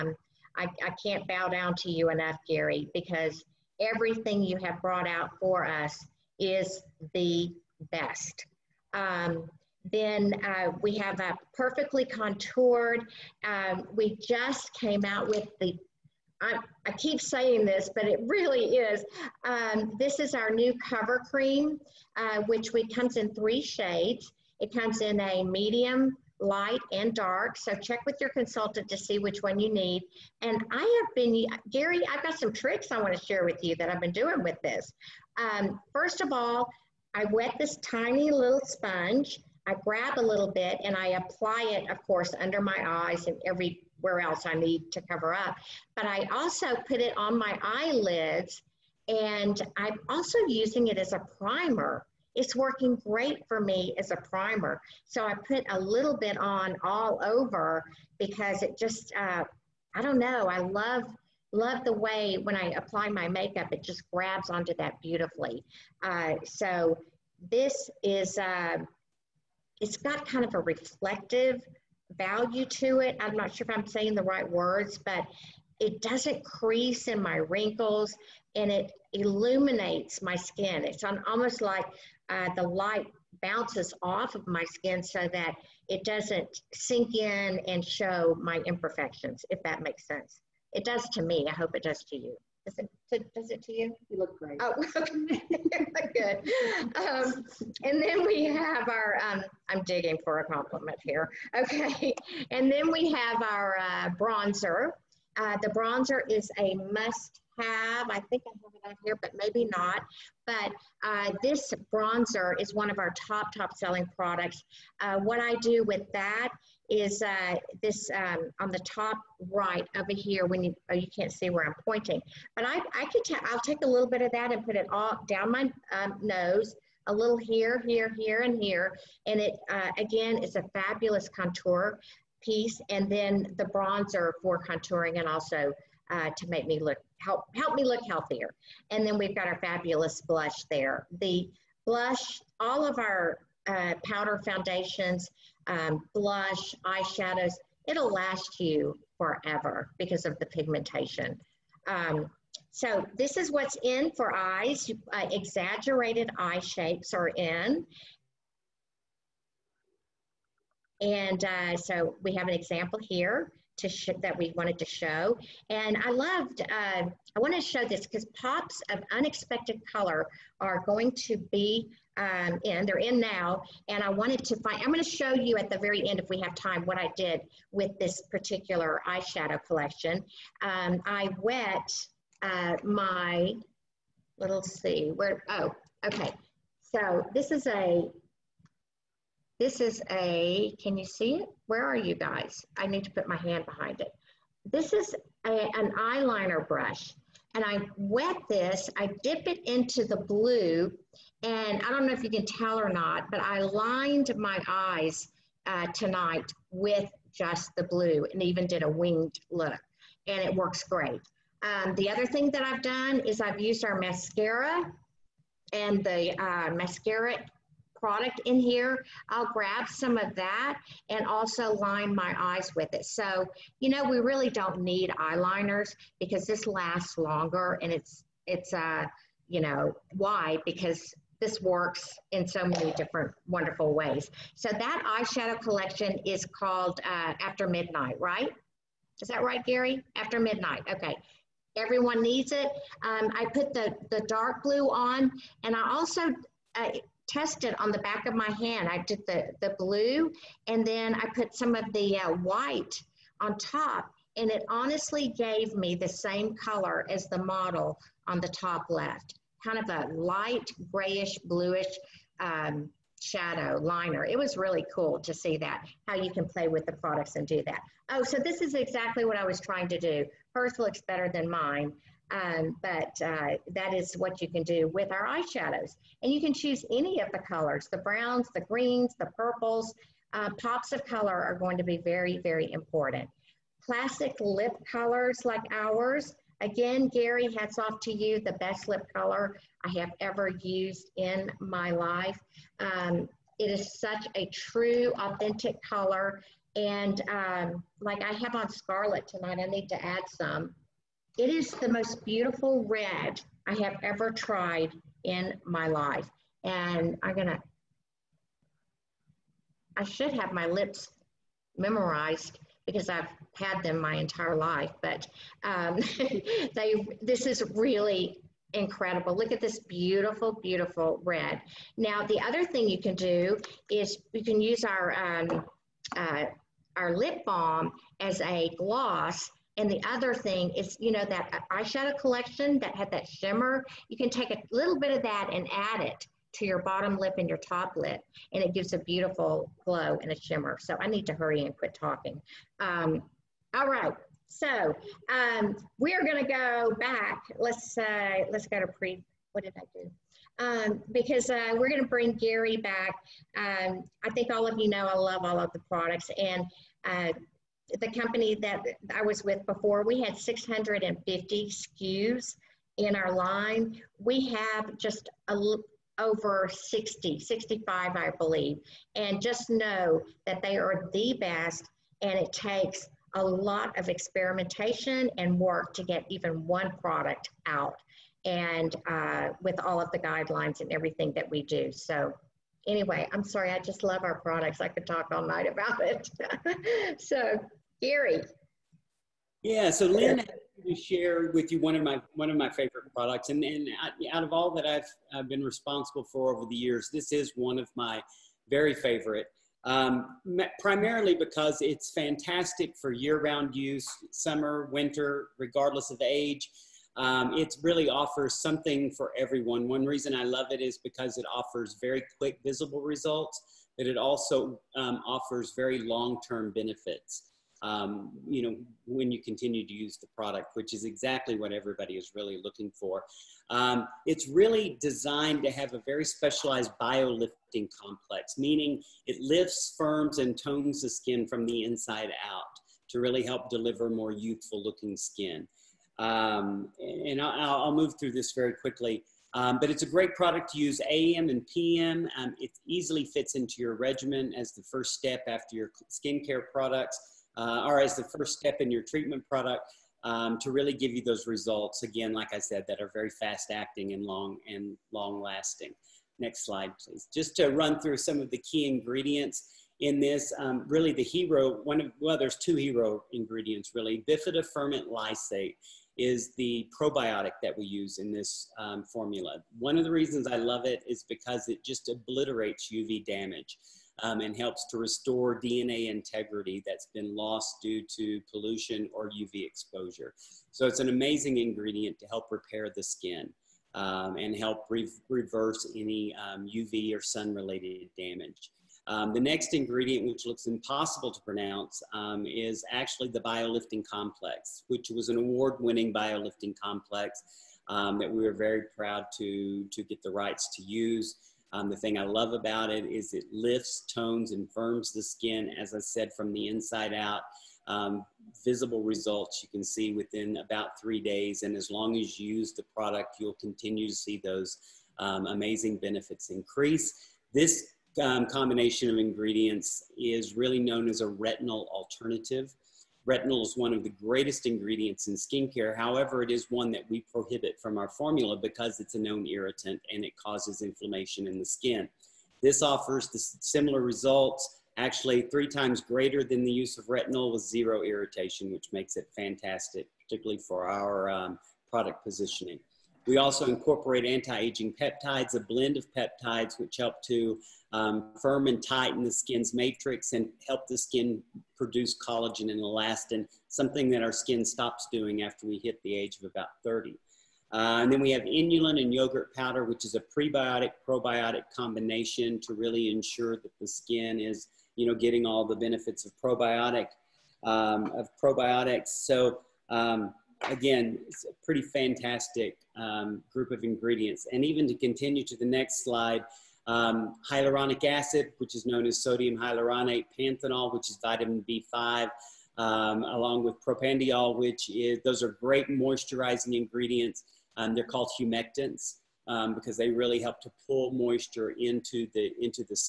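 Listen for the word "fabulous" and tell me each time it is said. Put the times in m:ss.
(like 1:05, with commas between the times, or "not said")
2:10, 2:19.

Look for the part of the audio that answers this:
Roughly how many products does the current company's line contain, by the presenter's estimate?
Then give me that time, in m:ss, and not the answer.
6:07.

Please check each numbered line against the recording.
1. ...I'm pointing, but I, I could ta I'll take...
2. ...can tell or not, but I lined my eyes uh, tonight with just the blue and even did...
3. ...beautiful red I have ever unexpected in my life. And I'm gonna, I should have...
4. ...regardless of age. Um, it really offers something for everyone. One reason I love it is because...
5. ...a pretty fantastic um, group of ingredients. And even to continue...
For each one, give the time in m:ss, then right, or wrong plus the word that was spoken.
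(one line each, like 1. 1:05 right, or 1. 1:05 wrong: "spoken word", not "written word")
1. 2:01 right
2. 3:22 right
3. 5:02 wrong: "tried", not "unexpected"
4. 6:45 right
5. 9:31 right.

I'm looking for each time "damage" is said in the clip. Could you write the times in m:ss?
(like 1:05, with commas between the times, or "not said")
7:53, 8:08.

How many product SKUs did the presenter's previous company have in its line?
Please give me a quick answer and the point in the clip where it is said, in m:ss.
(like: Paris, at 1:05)
650, at 6:00.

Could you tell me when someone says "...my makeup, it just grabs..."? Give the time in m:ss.
1:03.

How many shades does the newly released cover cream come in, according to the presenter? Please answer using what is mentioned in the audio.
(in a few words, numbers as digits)
3.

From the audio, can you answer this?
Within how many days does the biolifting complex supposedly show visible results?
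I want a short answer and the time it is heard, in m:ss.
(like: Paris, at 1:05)
3 days, at 8:31.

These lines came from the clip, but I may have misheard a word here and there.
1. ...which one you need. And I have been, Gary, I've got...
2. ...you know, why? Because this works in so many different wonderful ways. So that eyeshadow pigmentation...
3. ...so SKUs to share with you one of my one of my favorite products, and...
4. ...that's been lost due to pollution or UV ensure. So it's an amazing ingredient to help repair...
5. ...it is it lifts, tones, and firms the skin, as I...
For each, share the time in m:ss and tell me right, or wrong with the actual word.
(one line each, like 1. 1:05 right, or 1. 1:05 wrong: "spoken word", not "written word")
1. 0:29 right
2. 3:49 wrong: "collection", not "pigmentation"
3. 6:29 wrong: "Lynn", not "SKUs"
4. 7:56 wrong: "exposure", not "ensure"
5. 8:22 right.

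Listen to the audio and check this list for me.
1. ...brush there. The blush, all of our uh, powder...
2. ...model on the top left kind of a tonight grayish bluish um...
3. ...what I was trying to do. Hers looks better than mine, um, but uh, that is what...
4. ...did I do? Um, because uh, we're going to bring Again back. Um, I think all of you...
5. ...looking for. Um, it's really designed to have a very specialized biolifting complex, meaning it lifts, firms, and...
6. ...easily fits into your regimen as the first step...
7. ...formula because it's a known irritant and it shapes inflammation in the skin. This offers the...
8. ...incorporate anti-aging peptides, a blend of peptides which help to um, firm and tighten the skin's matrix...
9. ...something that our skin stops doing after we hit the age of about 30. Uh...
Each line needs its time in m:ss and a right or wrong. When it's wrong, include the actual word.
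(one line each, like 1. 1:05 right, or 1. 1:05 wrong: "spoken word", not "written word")
1. 2:20 wrong: "blush", not "brush"
2. 4:17 wrong: "light", not "tonight"
3. 4:29 right
4. 5:49 wrong: "Gary", not "Again"
5. 7:02 right
6. 7:22 right
7. 8:48 wrong: "causes", not "shapes"
8. 9:03 right
9. 9:13 right.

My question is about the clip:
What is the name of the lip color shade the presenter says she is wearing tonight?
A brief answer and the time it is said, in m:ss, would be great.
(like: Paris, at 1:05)
Scarlet, at 4:58.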